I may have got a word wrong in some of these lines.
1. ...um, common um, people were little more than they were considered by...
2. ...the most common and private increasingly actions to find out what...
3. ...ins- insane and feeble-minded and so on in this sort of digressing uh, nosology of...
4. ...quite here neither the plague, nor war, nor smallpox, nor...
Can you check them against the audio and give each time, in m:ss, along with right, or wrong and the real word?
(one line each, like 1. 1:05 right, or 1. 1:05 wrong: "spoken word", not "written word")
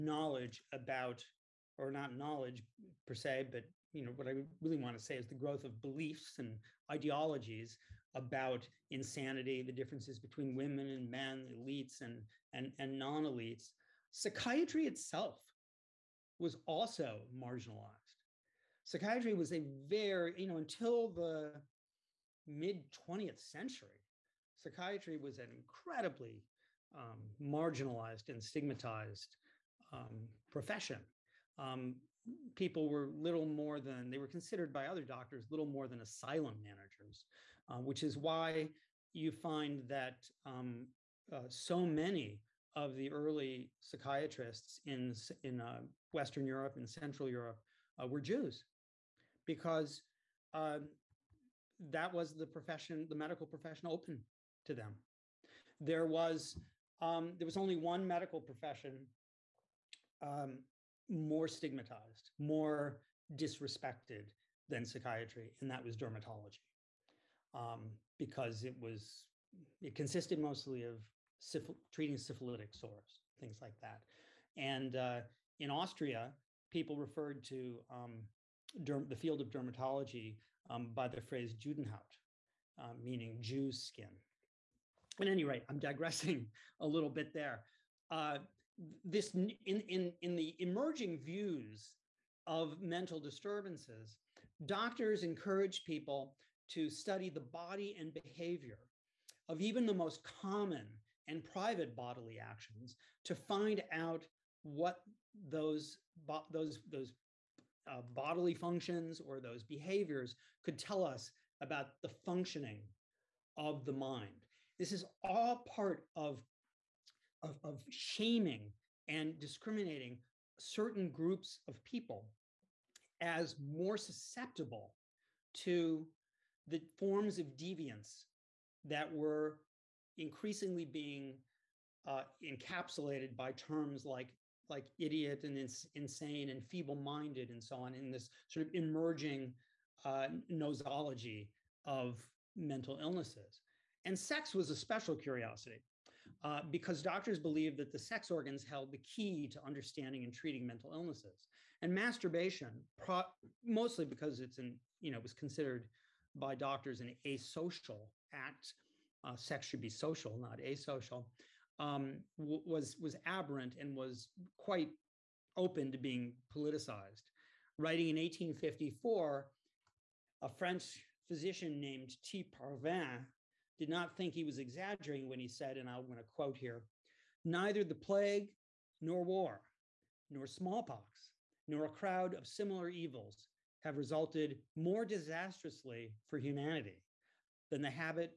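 1. 0:29 wrong: "profession", not "common"
2. 1:39 wrong: "bodily", not "increasingly"
3. 2:15 wrong: "emerging", not "digressing"
4. 2:56 wrong: "quote", not "quite".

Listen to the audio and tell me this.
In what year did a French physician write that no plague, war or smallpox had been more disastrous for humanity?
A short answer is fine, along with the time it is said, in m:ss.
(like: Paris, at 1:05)
1854, at 2:48.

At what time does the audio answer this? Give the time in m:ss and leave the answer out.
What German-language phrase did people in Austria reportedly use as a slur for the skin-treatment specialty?
1:21.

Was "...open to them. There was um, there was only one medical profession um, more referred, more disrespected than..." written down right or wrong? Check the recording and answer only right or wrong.
wrong.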